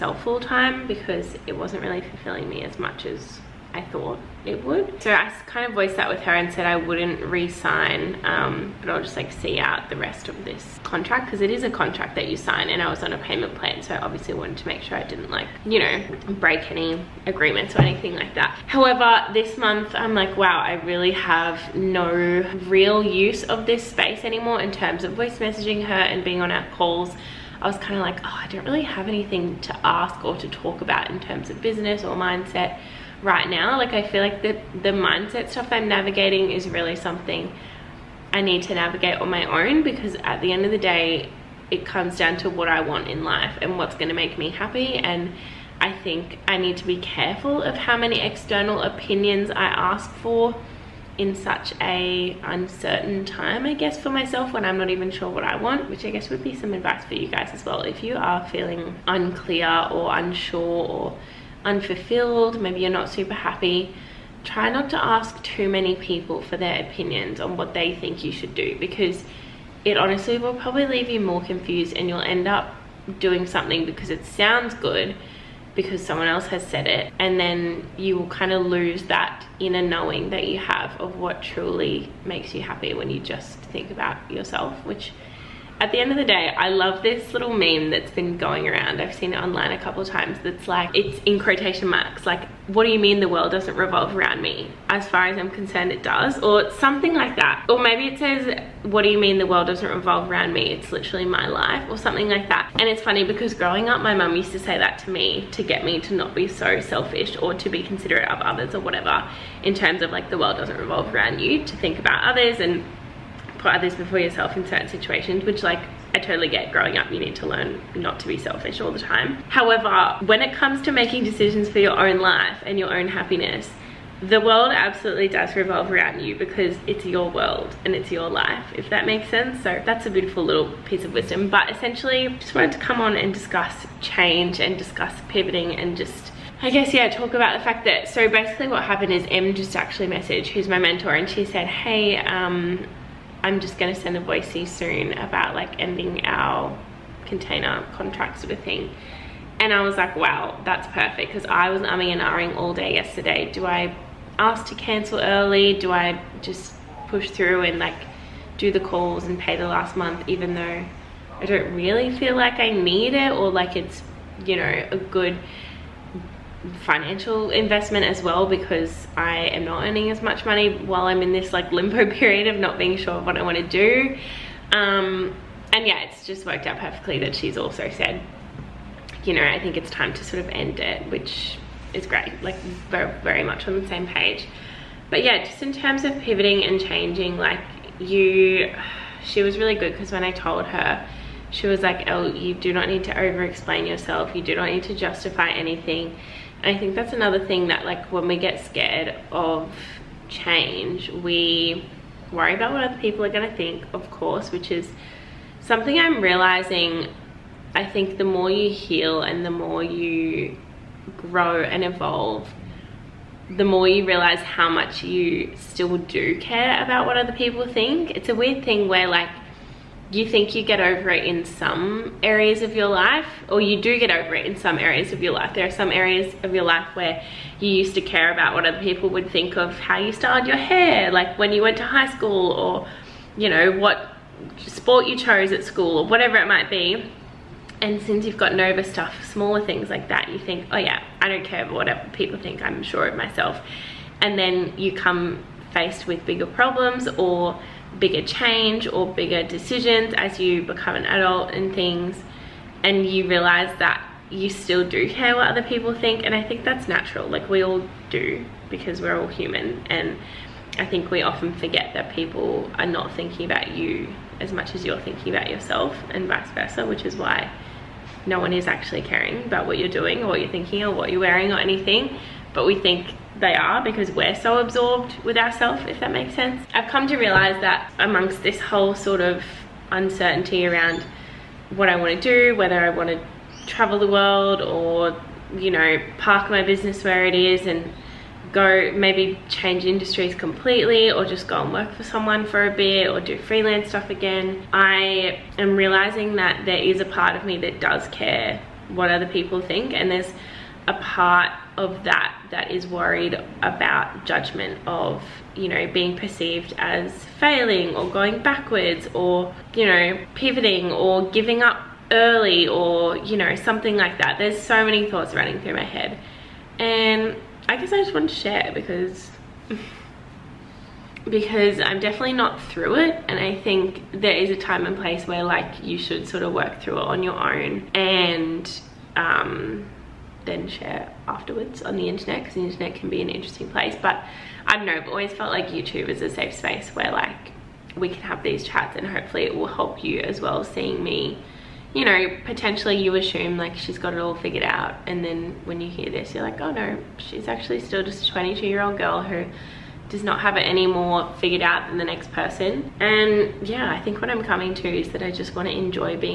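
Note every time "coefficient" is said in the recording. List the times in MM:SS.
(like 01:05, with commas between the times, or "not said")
not said.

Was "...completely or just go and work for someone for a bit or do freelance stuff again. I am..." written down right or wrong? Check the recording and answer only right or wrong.
right.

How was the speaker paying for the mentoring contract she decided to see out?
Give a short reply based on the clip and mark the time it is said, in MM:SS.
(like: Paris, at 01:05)
Payment plan, at 00:13.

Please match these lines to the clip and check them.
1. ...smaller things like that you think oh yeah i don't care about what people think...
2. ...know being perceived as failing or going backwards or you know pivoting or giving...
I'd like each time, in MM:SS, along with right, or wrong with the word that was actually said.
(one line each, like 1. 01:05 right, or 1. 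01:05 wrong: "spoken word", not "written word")
1. 03:59 right
2. 05:05 right.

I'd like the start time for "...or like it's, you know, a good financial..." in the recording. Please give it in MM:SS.
02:43.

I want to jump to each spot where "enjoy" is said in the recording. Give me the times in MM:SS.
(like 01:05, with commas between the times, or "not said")
05:55.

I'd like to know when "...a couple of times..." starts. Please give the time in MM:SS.
01:29.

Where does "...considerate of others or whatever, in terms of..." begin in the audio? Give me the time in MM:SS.
01:47.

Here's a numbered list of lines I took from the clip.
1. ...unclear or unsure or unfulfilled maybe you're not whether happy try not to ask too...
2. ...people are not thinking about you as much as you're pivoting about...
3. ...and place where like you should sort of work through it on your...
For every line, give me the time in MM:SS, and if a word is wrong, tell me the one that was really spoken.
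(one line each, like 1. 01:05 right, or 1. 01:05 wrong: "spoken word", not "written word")
1. 00:59 wrong: "super", not "whether"
2. 04:22 wrong: "thinking", not "pivoting"
3. 05:24 right.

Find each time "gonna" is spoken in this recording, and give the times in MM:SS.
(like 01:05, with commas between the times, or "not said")
02:23, 03:23.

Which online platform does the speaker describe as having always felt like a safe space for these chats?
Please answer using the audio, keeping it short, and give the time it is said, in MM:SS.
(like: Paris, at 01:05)
YouTube, at 05:35.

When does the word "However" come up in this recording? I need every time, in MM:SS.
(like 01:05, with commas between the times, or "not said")
00:18, 01:59.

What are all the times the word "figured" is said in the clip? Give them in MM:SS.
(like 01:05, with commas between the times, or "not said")
05:44, 05:51.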